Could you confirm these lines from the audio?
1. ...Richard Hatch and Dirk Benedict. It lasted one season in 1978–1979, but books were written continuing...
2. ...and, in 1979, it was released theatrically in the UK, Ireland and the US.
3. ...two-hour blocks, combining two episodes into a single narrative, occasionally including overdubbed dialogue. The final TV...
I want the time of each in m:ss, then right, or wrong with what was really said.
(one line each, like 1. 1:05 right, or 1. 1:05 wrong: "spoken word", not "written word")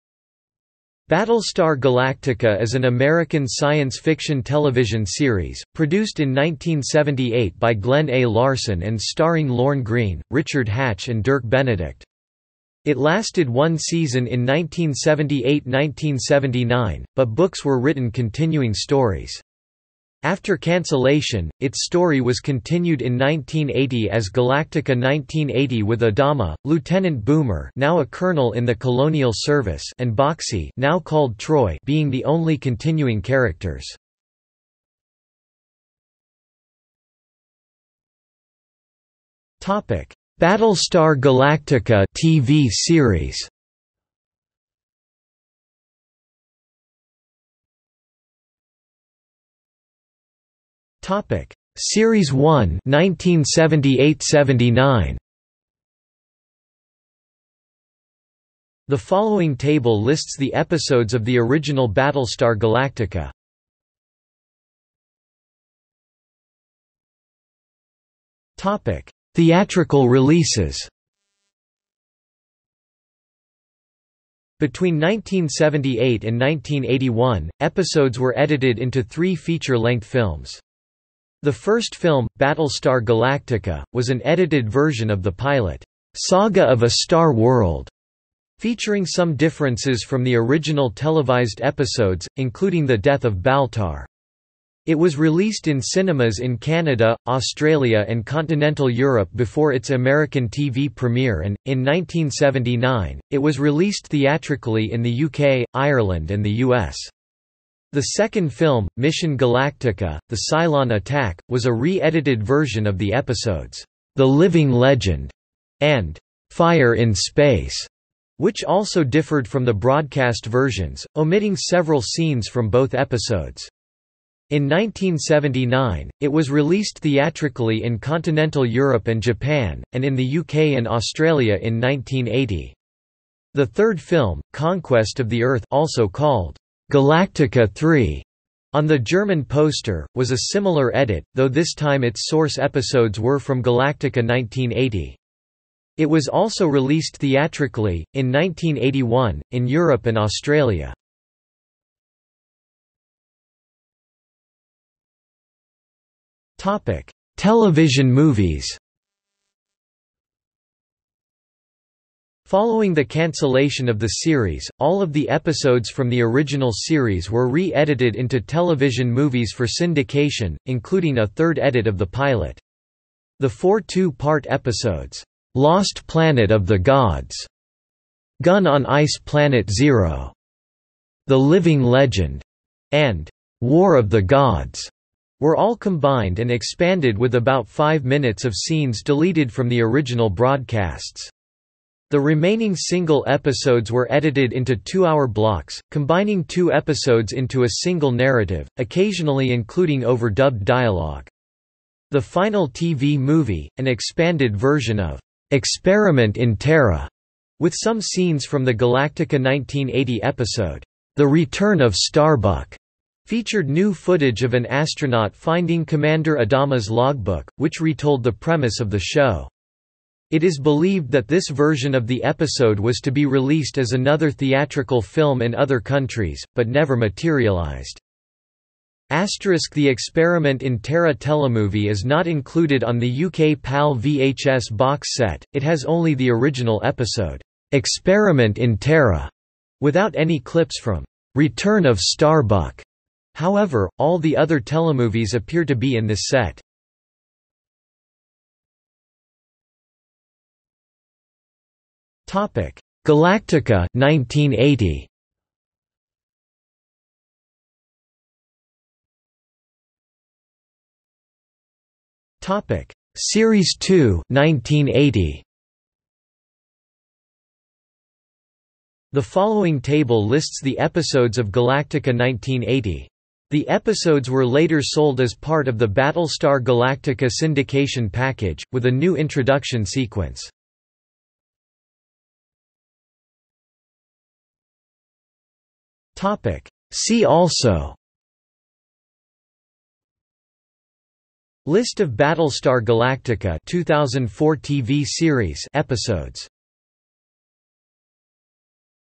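1. 0:10 right
2. 1:41 right
3. 3:14 right.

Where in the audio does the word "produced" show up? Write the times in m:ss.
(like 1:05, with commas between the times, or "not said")
0:05.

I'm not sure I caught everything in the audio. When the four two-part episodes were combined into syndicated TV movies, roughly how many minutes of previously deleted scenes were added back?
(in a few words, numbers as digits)
5.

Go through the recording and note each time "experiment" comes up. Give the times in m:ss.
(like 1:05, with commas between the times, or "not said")
3:25, 3:49, 3:57.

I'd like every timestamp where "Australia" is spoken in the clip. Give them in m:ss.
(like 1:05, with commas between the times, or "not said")
1:37, 2:10, 2:30.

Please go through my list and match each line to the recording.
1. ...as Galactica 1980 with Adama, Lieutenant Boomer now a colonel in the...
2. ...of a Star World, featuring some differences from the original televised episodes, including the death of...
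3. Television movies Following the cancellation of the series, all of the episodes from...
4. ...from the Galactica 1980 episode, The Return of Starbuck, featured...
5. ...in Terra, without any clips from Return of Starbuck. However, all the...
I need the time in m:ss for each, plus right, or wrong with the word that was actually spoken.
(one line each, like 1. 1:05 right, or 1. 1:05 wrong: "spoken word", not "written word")
1. 0:24 right
2. 1:26 right
3. 2:37 right
4. 3:28 right
5. 3:58 right.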